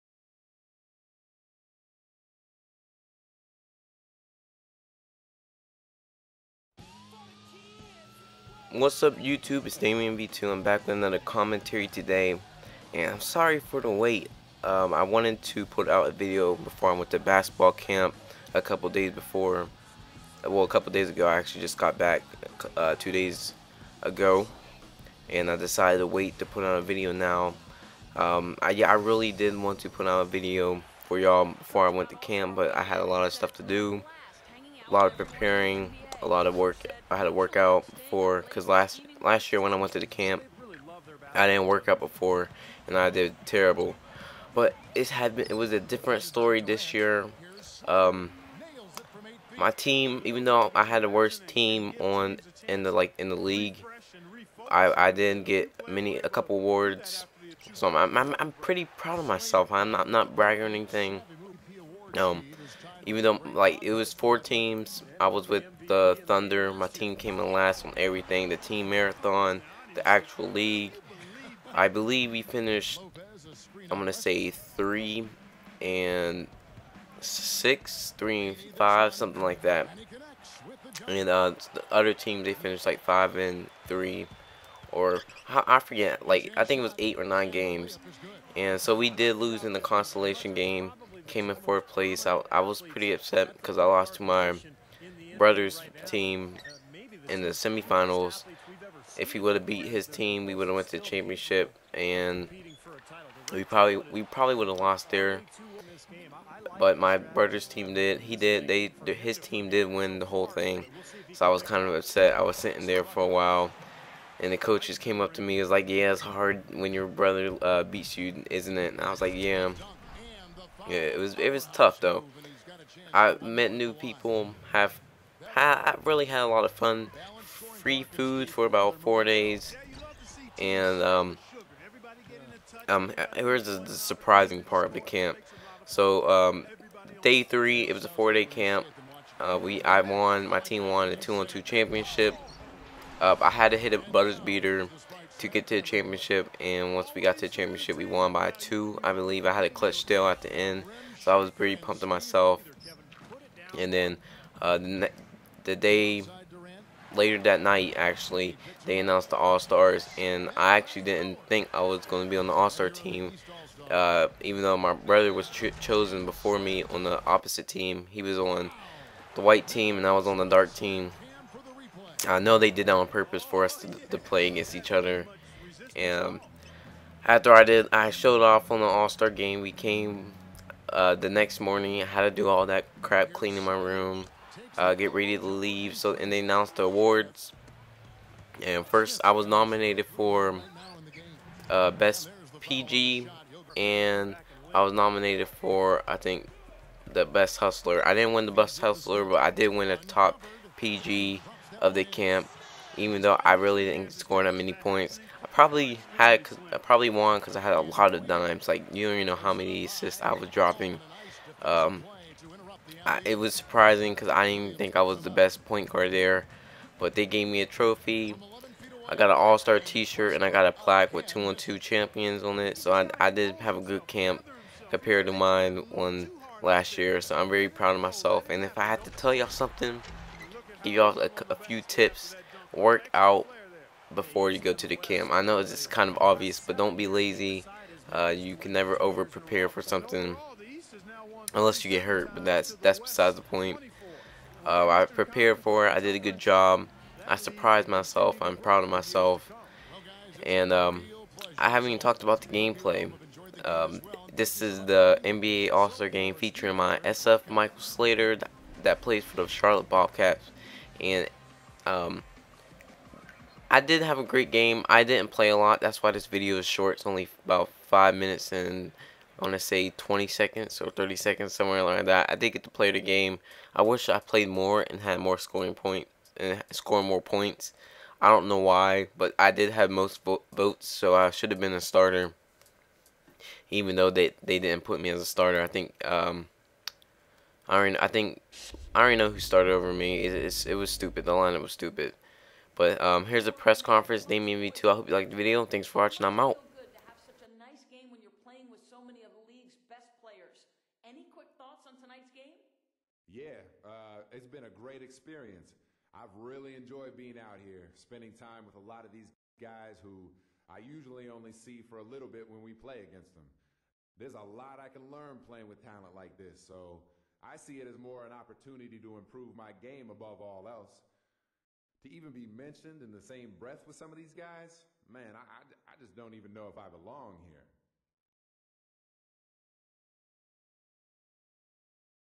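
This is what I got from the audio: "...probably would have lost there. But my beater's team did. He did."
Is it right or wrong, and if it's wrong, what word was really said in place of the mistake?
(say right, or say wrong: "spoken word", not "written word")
wrong: "brother", not "beater".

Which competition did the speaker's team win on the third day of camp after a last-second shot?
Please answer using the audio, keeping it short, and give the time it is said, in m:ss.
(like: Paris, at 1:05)
two-on-two, at 2:21.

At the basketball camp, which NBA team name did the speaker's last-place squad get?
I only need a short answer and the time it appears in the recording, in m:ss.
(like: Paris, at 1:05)
Thunder, at 1:06.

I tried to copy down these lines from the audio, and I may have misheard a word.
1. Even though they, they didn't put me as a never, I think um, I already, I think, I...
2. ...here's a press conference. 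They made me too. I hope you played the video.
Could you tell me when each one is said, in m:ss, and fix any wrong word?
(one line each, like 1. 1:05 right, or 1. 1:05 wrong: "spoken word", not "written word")
1. 4:43 wrong: "starter", not "never"
2. 4:53 wrong: "liked", not "played".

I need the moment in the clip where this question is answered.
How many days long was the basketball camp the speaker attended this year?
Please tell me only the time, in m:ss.
2:18.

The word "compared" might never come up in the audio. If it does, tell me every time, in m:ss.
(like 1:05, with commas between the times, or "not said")
3:44.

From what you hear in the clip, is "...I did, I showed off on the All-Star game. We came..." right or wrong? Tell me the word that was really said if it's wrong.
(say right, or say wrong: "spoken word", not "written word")
right.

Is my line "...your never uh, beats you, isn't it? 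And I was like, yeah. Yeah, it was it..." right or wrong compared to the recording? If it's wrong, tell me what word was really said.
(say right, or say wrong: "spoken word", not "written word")
wrong: "brother", not "never".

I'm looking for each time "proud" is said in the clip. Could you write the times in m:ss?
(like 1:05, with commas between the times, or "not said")
0:58, 3:47, 4:08.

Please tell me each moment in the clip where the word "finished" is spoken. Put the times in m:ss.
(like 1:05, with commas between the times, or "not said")
1:12, 1:22.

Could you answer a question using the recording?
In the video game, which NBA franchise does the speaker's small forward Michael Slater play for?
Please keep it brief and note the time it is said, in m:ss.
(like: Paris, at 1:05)
Charlotte Bobcats, at 4:19.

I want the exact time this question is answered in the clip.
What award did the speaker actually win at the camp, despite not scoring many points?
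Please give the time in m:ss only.
3:19.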